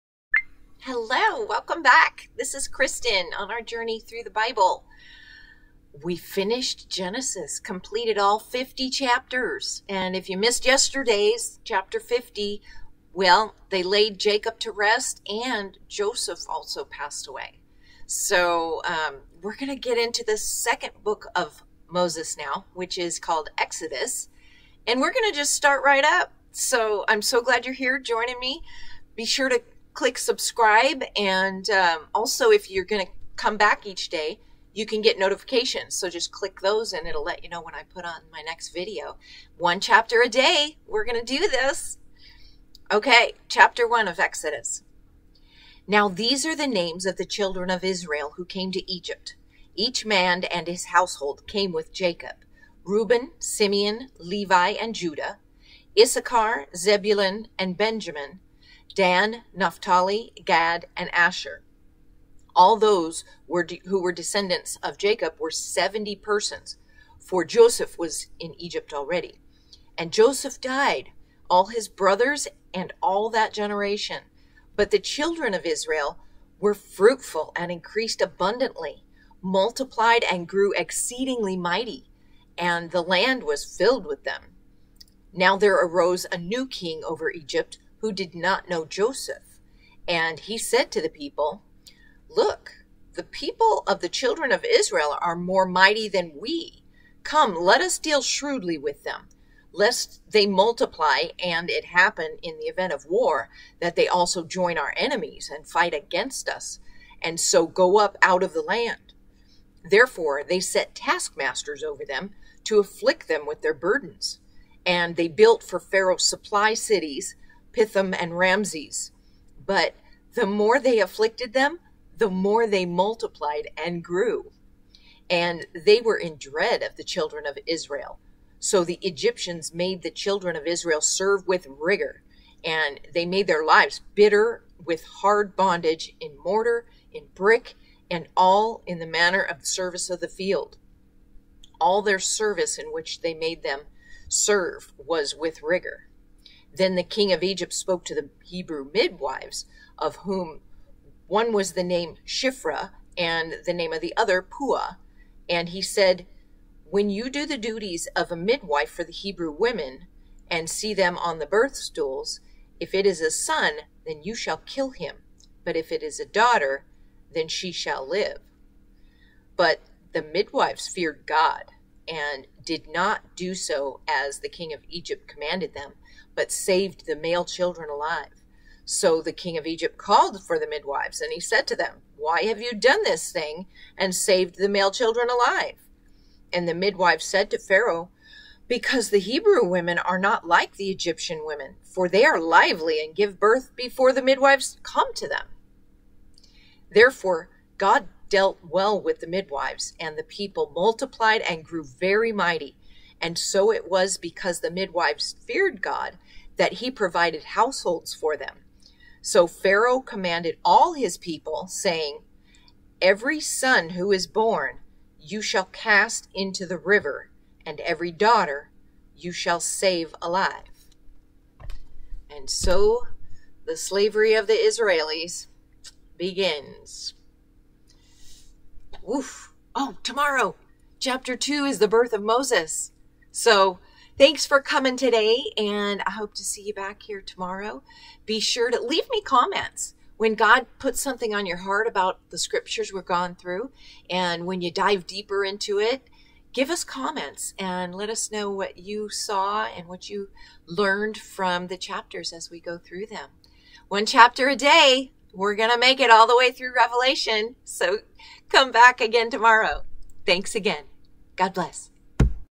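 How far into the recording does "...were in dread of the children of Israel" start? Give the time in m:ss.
2:06.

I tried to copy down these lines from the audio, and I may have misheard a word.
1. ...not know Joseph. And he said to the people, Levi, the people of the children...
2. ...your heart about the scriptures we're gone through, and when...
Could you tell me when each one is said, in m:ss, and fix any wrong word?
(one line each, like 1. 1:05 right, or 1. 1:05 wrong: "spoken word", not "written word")
1. 1:28 wrong: "Look", not "Levi"
2. 4:01 right.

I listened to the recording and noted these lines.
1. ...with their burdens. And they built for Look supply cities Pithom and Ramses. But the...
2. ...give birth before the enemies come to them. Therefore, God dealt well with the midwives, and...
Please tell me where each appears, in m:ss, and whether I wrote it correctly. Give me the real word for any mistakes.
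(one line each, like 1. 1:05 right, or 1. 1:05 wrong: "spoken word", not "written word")
1. 1:53 wrong: "Pharaoh", not "Look"
2. 3:13 wrong: "midwives", not "enemies".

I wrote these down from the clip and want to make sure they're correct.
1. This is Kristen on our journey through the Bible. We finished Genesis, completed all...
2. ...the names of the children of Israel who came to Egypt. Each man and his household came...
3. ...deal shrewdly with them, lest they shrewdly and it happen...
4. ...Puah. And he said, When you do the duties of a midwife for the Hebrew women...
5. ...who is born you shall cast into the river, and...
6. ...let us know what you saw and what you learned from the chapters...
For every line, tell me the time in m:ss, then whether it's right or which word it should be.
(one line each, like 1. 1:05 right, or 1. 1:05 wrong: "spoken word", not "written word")
1. 0:02 right
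2. 0:46 right
3. 1:37 wrong: "multiply", not "shrewdly"
4. 2:34 right
5. 3:33 right
6. 4:07 right.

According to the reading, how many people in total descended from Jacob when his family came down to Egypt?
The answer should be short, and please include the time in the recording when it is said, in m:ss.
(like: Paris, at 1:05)
70, at 1:05.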